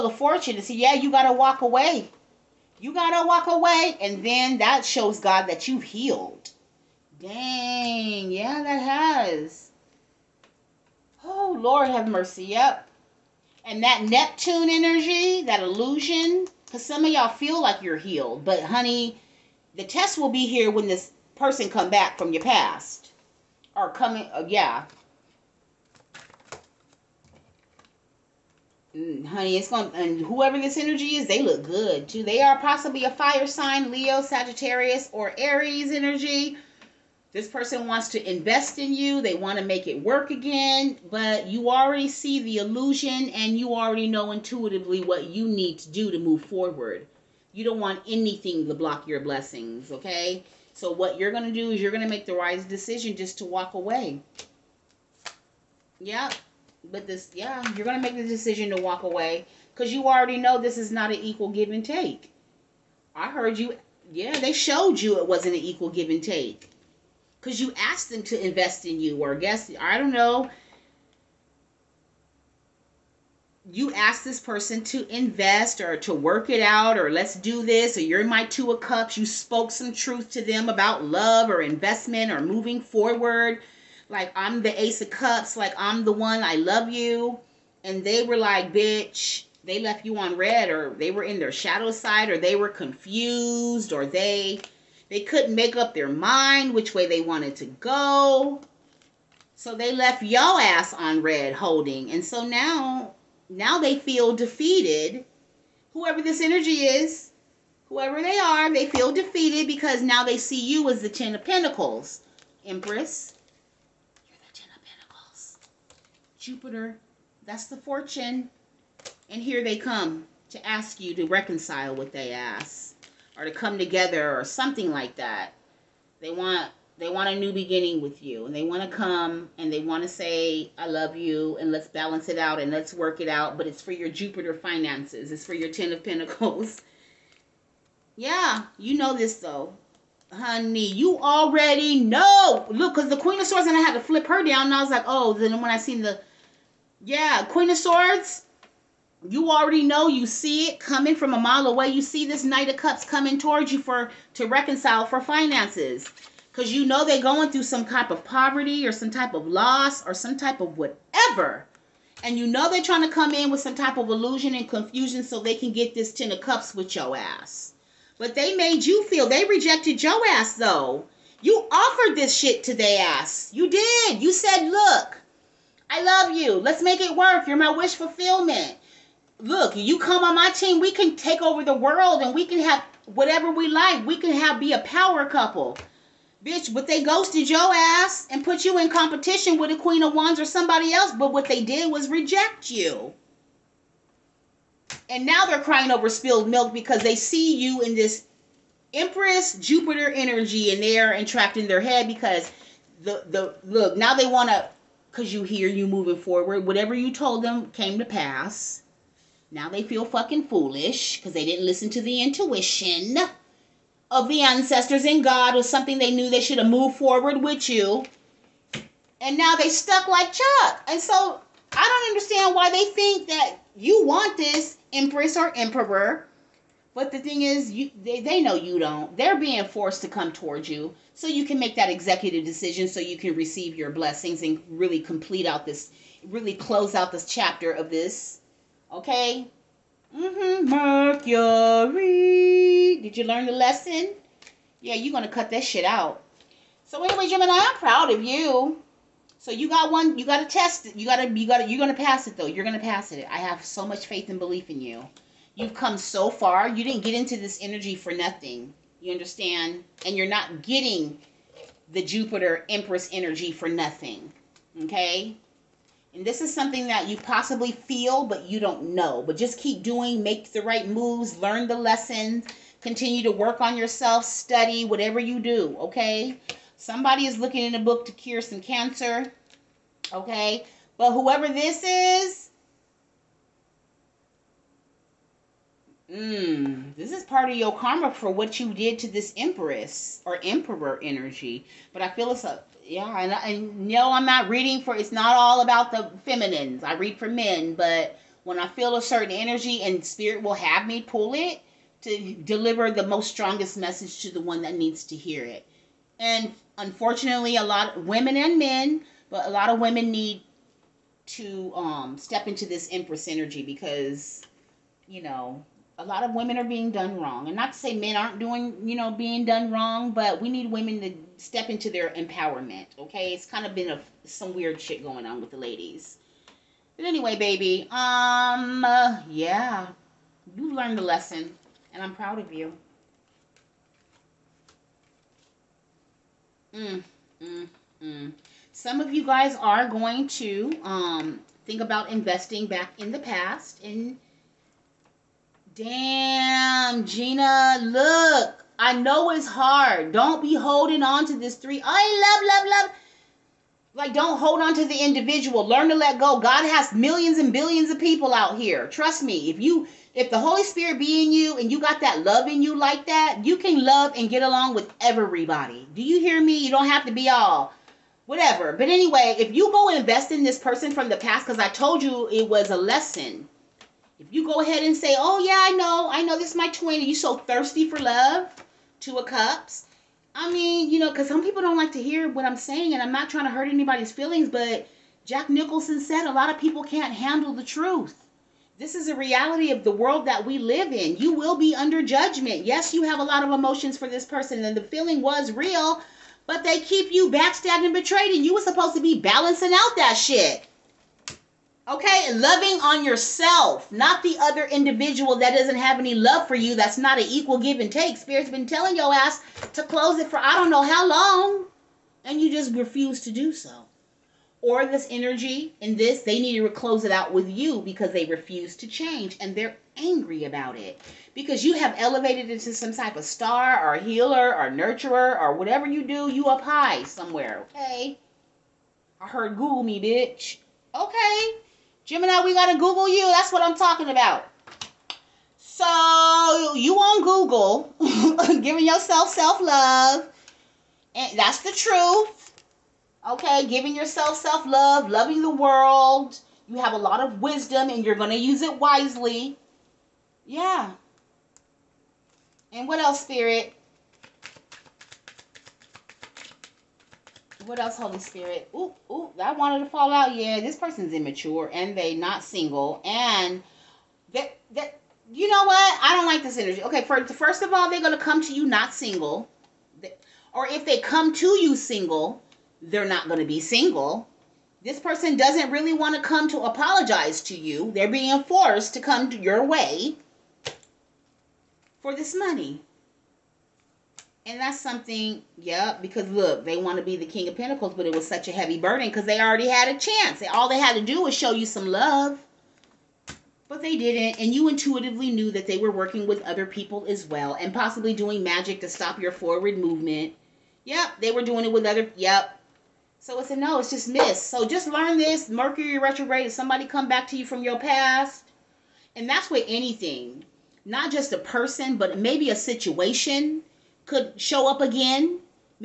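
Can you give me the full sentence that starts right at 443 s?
Okay, giving yourself self love, loving the world.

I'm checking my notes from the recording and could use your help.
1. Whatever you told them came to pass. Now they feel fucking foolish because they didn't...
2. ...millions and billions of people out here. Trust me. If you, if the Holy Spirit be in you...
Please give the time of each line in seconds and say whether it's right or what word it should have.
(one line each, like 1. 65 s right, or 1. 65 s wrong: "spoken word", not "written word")
1. 206 s right
2. 356 s right.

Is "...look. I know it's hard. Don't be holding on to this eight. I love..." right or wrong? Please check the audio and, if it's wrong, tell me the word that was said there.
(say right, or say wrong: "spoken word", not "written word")
wrong: "three", not "eight".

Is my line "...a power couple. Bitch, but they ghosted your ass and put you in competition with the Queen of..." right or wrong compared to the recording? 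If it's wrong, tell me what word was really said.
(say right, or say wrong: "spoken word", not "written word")
right.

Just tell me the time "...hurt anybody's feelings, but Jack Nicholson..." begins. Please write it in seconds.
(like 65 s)
383 s.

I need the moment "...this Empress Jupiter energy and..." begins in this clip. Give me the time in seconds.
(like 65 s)
197 s.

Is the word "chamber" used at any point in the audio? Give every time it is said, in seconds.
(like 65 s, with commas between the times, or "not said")
not said.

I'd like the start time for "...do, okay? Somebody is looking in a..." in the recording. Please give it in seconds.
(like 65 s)
275 s.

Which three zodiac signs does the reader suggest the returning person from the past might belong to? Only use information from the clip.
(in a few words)
Leo, Sagittarius, or Aries.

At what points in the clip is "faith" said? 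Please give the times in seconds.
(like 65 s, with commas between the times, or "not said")
254 s.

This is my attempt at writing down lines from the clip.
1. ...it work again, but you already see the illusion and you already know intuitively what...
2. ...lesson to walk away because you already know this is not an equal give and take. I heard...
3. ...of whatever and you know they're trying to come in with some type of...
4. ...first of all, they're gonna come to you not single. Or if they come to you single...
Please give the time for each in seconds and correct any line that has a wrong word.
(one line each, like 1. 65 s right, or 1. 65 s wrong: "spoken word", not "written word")
1. 39 s right
2. 58 s wrong: "decision", not "lesson"
3. 160 s right
4. 467 s right.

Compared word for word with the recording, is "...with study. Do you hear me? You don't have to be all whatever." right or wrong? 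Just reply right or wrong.
wrong.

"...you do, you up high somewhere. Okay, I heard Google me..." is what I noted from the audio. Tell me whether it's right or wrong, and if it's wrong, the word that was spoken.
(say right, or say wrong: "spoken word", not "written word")
right.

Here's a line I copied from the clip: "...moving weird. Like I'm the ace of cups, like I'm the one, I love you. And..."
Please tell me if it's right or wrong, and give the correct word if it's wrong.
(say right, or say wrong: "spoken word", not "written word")
wrong: "forward", not "weird".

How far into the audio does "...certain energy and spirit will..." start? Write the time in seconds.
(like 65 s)
299 s.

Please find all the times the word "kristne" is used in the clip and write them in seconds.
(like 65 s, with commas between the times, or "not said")
not said.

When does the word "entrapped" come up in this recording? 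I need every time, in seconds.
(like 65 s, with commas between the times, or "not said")
201 s.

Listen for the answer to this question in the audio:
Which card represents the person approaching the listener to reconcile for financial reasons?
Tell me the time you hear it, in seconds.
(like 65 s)
152 s.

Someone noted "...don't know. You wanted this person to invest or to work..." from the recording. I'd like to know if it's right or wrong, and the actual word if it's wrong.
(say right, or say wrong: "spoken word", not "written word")
wrong: "asked", not "wanted".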